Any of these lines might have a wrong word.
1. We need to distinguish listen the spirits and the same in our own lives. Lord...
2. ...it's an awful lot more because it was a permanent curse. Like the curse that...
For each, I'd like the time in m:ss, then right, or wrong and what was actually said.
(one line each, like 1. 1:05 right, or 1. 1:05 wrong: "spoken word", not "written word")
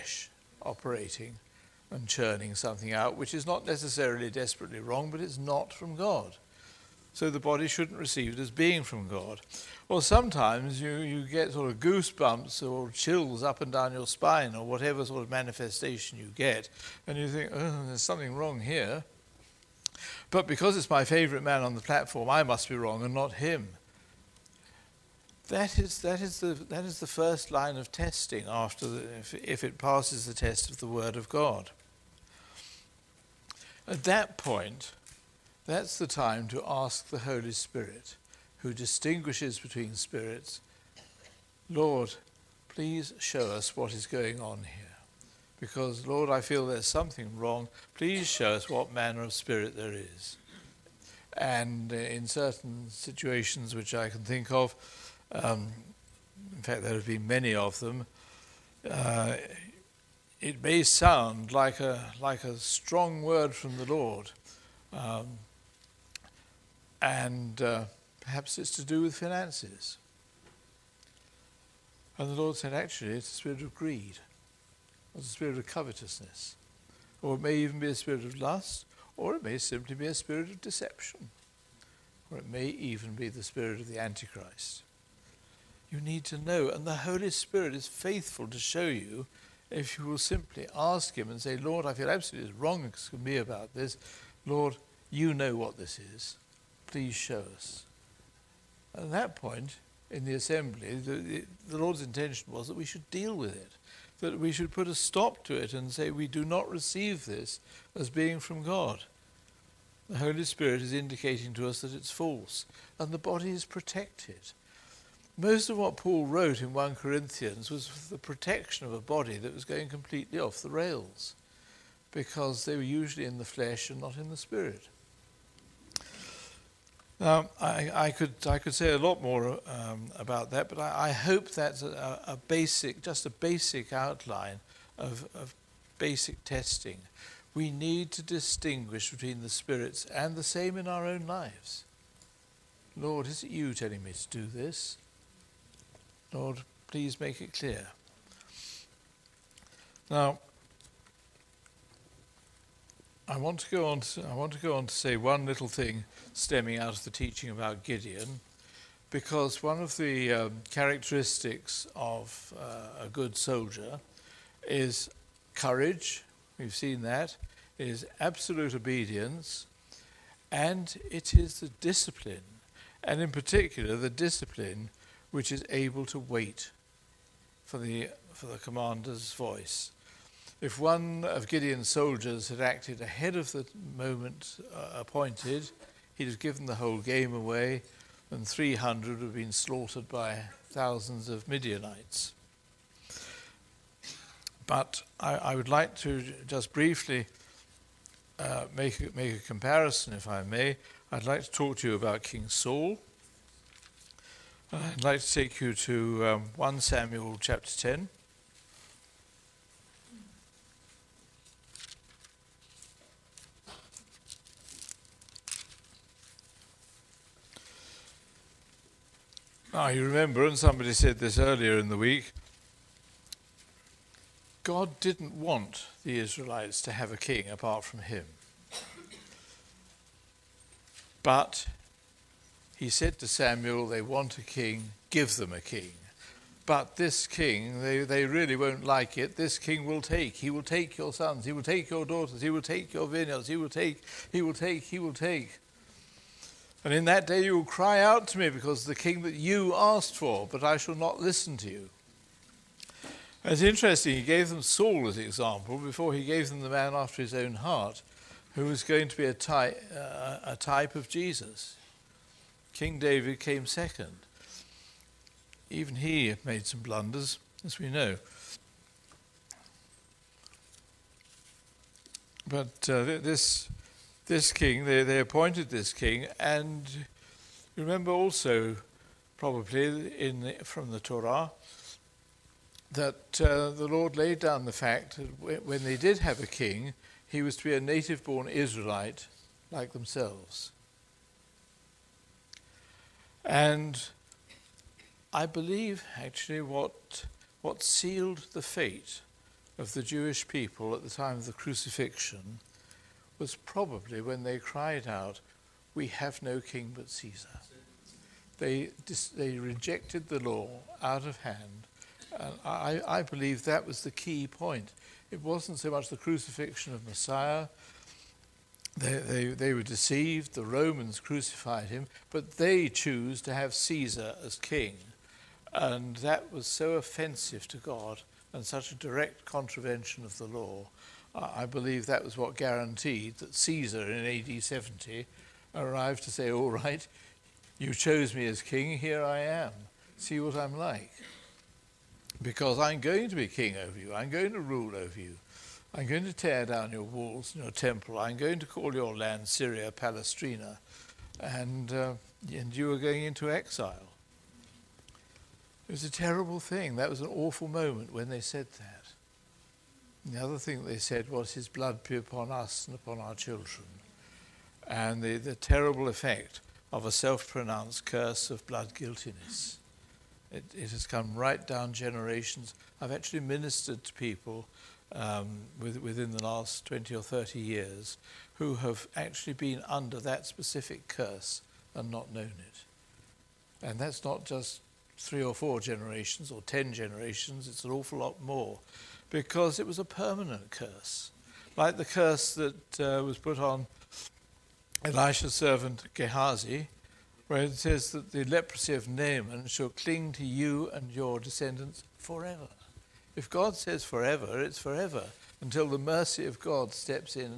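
1. 2:17 wrong: "between", not "listen"
2. 6:27 right.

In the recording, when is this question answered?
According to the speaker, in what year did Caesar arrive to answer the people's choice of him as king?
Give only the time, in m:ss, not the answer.
5:34.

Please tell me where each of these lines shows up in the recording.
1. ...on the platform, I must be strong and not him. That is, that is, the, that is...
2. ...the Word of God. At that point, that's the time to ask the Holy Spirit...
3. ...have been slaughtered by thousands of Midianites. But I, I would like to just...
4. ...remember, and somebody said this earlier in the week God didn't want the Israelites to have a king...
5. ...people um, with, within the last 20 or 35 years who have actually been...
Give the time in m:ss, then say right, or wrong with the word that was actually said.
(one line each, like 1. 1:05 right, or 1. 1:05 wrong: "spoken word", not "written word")
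1. 0:21 wrong: "wrong", not "strong"
2. 0:30 right
3. 3:09 right
4. 3:40 right
5. 6:14 wrong: "30", not "35".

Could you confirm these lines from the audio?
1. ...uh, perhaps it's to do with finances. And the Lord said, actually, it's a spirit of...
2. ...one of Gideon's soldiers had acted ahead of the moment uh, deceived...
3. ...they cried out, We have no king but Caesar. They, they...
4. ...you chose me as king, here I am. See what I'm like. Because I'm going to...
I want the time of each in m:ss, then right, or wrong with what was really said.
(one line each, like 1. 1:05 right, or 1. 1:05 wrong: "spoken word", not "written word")
1. 1:07 right
2. 3:00 wrong: "appointed", not "deceived"
3. 5:04 right
4. 5:37 right.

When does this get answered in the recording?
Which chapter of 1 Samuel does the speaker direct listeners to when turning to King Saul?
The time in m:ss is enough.
3:27.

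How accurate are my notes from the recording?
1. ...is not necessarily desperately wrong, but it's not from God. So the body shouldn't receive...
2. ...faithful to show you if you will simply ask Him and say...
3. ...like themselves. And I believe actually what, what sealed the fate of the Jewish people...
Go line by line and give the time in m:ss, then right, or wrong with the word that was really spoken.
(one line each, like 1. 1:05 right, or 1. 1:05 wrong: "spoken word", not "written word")
1. 0:03 right
2. 1:27 right
3. 4:49 right.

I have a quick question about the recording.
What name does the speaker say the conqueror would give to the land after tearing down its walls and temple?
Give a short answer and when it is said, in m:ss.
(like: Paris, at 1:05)
Syria Palaestina, at 5:49.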